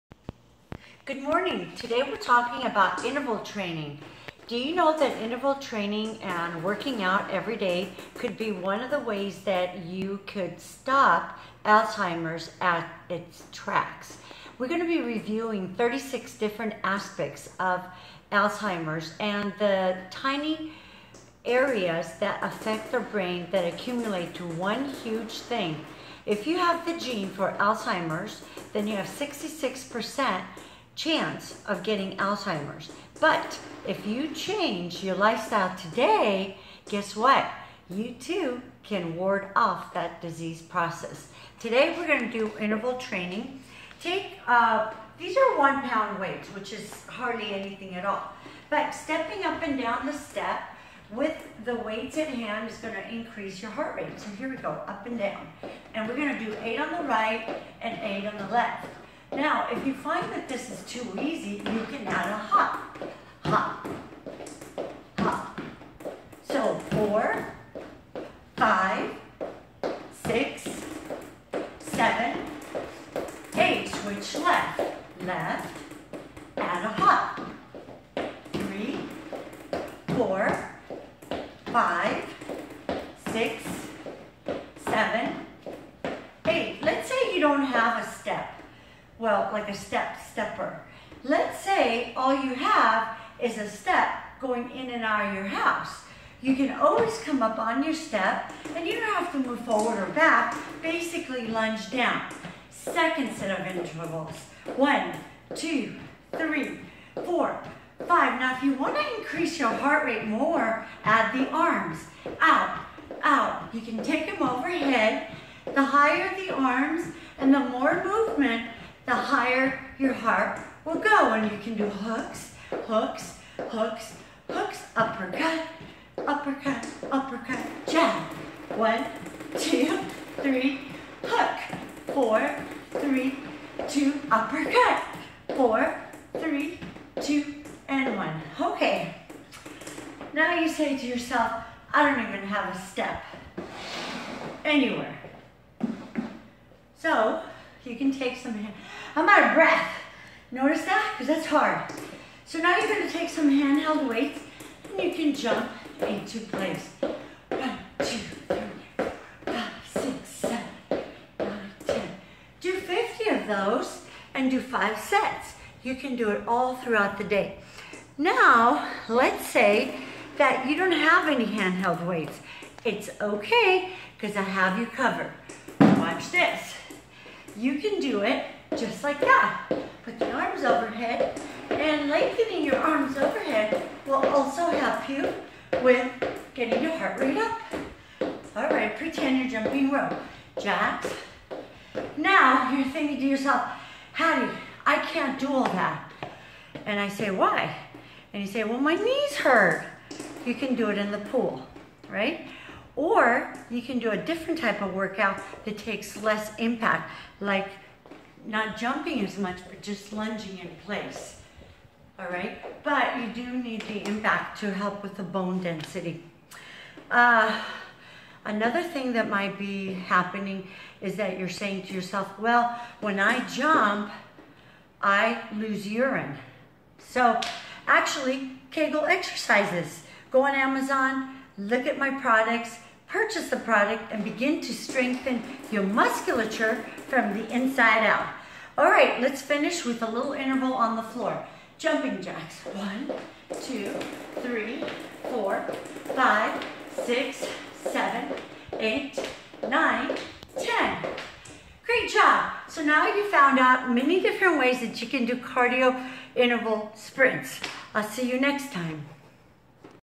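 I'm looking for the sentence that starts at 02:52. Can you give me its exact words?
It's okay, because I have you covered.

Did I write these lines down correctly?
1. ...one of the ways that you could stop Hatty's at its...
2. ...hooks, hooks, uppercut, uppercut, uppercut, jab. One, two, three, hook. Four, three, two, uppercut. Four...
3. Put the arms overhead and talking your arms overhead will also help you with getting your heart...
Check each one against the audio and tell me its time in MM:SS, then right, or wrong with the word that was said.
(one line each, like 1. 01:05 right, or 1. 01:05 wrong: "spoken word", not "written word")
1. 00:08 wrong: "Alzheimer", not "Hatty"
2. 02:03 right
3. 03:00 wrong: "lengthening", not "talking".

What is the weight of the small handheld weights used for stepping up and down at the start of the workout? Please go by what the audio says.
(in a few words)
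1 pound.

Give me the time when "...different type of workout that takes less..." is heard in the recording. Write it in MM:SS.
03:24.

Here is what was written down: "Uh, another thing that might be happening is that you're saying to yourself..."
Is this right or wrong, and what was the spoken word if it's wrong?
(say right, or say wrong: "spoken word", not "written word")
right.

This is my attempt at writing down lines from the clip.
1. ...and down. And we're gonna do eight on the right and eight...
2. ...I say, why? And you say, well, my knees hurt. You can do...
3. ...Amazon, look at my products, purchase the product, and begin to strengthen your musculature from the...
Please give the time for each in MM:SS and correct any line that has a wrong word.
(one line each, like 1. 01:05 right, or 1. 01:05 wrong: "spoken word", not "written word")
1. 00:55 right
2. 03:16 right
3. 03:50 right.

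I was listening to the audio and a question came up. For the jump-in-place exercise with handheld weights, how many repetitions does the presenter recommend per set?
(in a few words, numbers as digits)
50.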